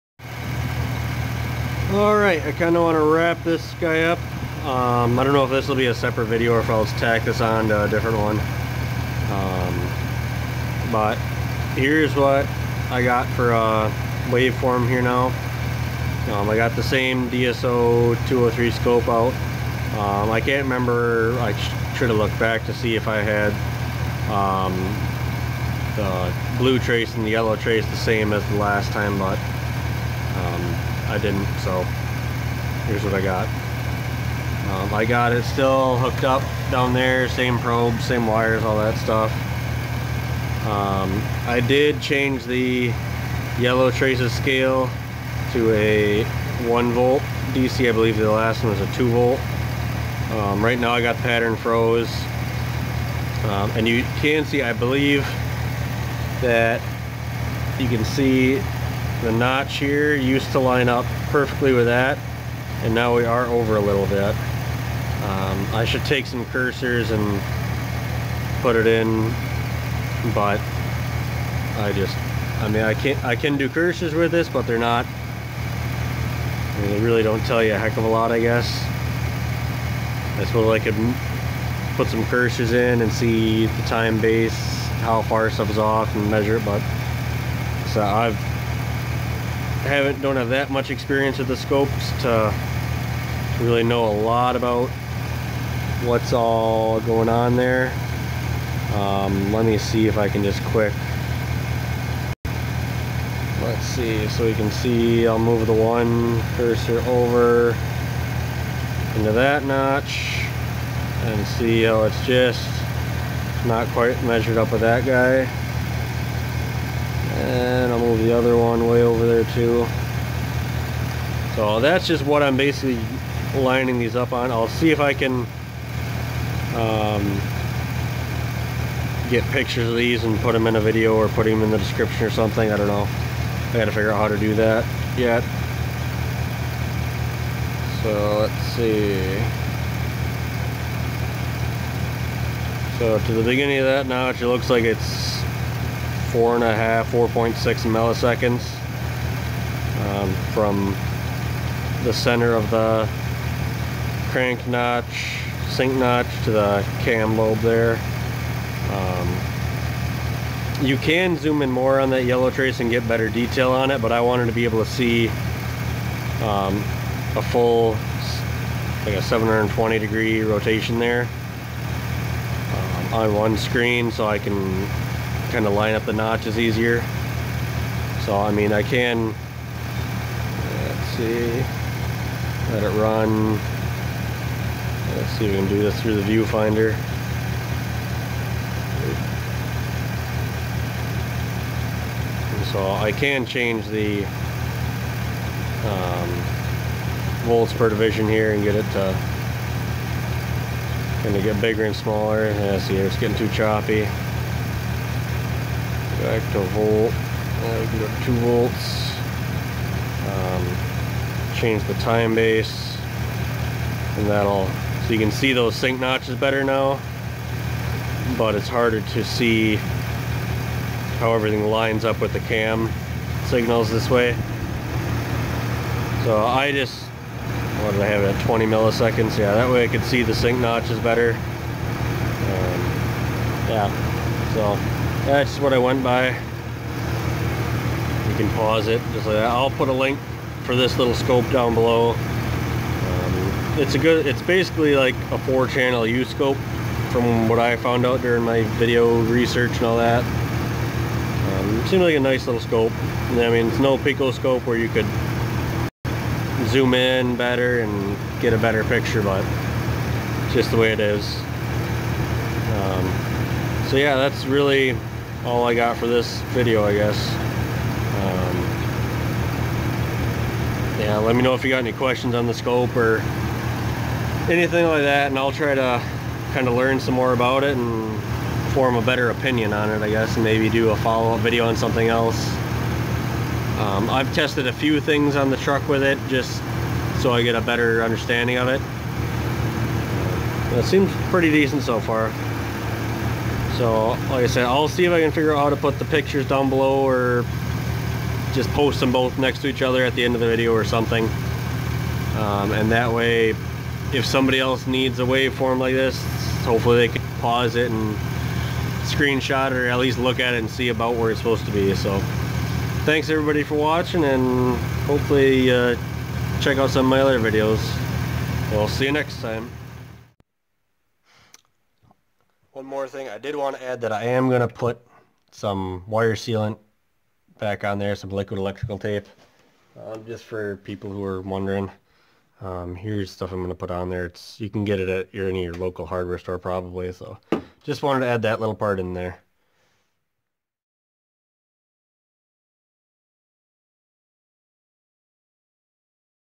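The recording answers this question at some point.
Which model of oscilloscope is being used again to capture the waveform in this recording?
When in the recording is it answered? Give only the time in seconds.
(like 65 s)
17 s.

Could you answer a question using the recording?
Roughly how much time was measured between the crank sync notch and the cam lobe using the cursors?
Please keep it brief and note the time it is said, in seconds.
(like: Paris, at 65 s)
4.6 milliseconds, at 147 s.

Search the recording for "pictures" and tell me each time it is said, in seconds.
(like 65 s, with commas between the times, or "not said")
129 s, 258 s, 296 s.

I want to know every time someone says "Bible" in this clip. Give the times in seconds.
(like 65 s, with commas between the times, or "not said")
not said.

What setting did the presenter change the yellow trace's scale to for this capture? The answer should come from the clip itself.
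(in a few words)
1 volt DC.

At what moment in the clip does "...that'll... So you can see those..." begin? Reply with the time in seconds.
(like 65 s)
214 s.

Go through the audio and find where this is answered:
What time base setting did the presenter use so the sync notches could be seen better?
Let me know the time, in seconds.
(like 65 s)
228 s.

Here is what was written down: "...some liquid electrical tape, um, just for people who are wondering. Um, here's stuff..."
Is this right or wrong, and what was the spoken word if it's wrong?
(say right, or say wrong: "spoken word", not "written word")
right.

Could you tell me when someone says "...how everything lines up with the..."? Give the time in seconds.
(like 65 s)
221 s.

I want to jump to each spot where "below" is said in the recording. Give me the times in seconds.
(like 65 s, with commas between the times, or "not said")
241 s, 296 s.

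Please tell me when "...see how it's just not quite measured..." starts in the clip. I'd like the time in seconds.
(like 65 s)
111 s.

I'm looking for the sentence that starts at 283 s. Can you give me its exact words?
Um, I've tested a few things on the truck with it, just so I get a better understanding of it.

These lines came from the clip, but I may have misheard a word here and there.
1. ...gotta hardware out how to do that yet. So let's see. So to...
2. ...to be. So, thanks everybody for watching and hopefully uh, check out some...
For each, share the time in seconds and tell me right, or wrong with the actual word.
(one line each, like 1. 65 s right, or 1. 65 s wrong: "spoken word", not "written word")
1. 133 s wrong: "figure", not "hardware"
2. 311 s right.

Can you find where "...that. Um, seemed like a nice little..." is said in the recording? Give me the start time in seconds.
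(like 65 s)
249 s.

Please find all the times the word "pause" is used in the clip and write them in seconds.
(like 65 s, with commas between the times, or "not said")
238 s, 307 s.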